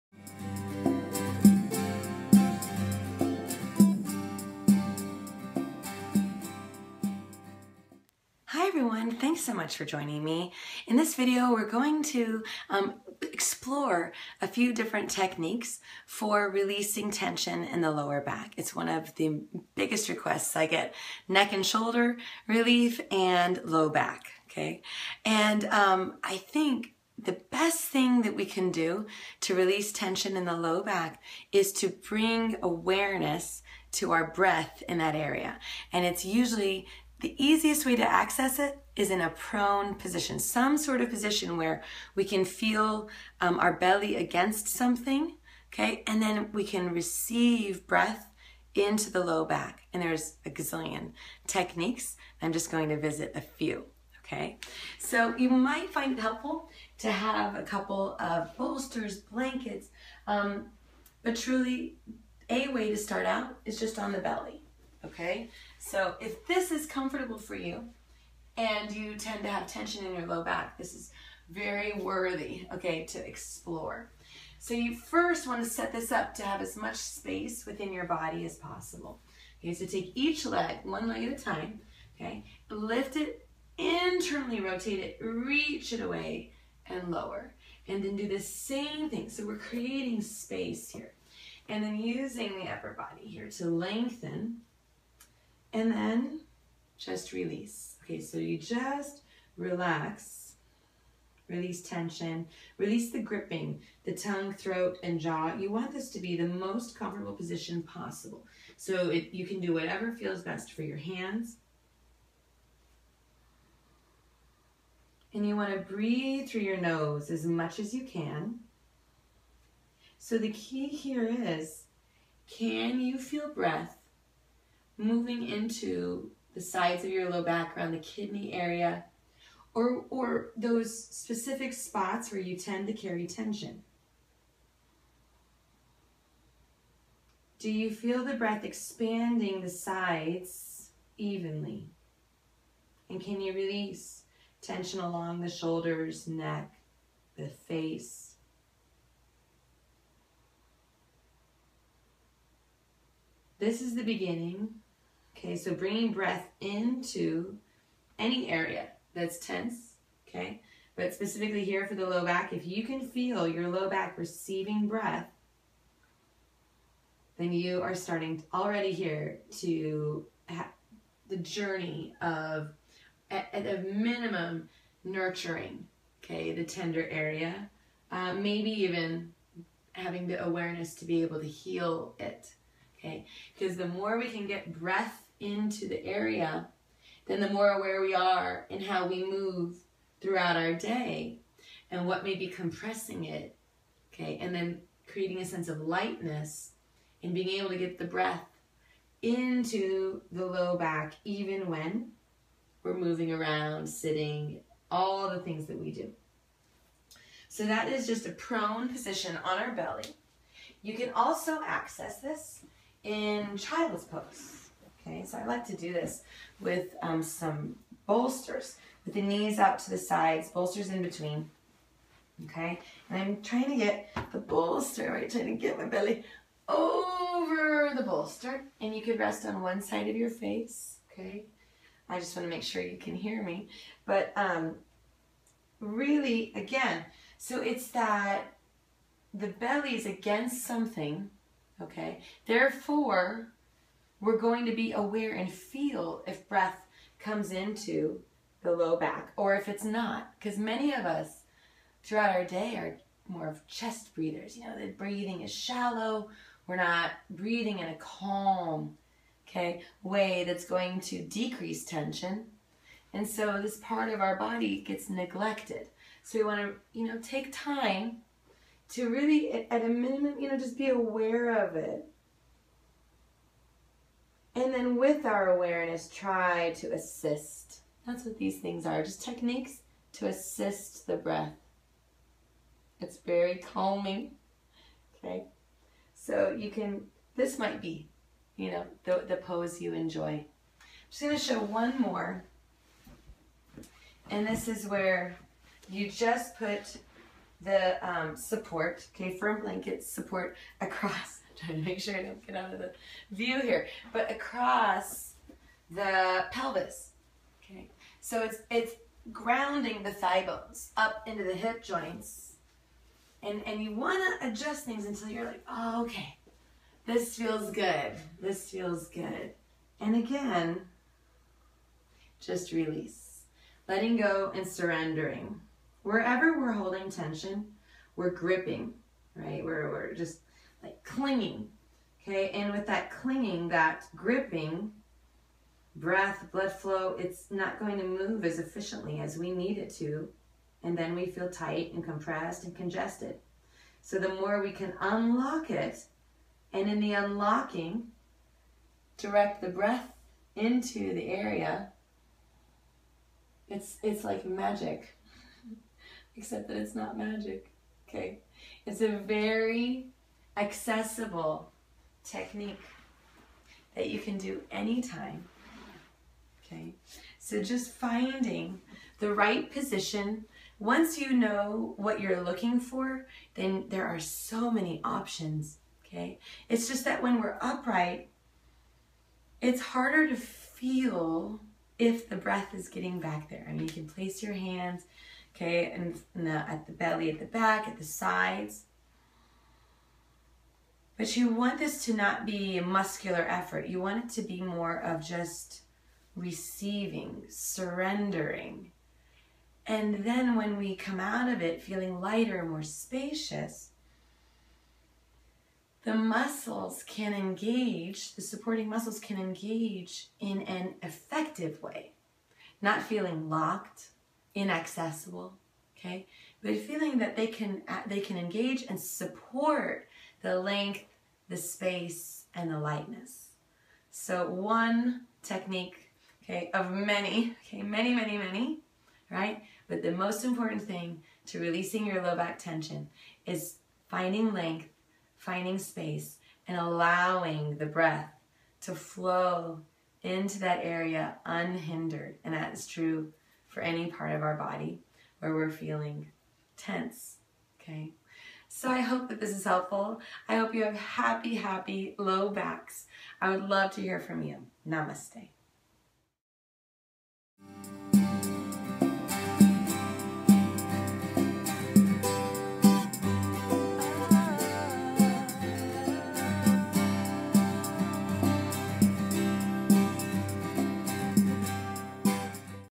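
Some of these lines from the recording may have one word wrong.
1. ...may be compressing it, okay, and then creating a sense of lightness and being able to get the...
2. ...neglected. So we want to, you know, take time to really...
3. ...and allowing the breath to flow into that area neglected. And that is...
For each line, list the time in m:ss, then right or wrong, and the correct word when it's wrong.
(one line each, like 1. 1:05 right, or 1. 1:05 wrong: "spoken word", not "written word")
1. 3:12 right
2. 4:25 right
3. 7:16 wrong: "unhindered", not "neglected".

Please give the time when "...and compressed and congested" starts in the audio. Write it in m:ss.
5:41.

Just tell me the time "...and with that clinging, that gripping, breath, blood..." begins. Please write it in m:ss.
5:32.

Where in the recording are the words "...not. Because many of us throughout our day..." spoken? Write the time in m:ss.
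4:09.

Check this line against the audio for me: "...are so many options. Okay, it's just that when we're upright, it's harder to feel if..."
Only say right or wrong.
right.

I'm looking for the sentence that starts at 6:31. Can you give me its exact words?
But you want this to not be a muscular effort.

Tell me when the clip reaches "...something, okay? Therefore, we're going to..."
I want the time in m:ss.
4:00.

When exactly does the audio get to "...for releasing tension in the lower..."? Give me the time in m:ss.
0:16.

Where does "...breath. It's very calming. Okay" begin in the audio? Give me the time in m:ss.
4:41.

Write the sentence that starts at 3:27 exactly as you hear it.
So that is just a prone position on our belly.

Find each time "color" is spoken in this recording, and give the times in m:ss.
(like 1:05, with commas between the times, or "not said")
not said.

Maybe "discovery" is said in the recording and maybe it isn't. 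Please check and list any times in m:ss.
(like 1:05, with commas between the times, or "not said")
not said.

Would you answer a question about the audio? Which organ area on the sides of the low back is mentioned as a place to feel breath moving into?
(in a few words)
kidney area.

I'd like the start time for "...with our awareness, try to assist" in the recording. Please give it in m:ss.
4:34.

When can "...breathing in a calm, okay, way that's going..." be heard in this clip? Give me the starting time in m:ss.
4:17.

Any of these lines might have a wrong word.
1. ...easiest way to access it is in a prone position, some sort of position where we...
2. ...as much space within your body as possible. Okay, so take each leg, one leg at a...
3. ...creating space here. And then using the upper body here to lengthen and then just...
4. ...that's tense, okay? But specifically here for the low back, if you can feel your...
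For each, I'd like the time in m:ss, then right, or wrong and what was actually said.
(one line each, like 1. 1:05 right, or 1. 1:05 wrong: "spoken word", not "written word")
1. 0:37 right
2. 1:16 right
3. 1:29 right
4. 2:39 right.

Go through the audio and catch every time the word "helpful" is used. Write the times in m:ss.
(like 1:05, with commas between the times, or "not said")
0:56, 7:29.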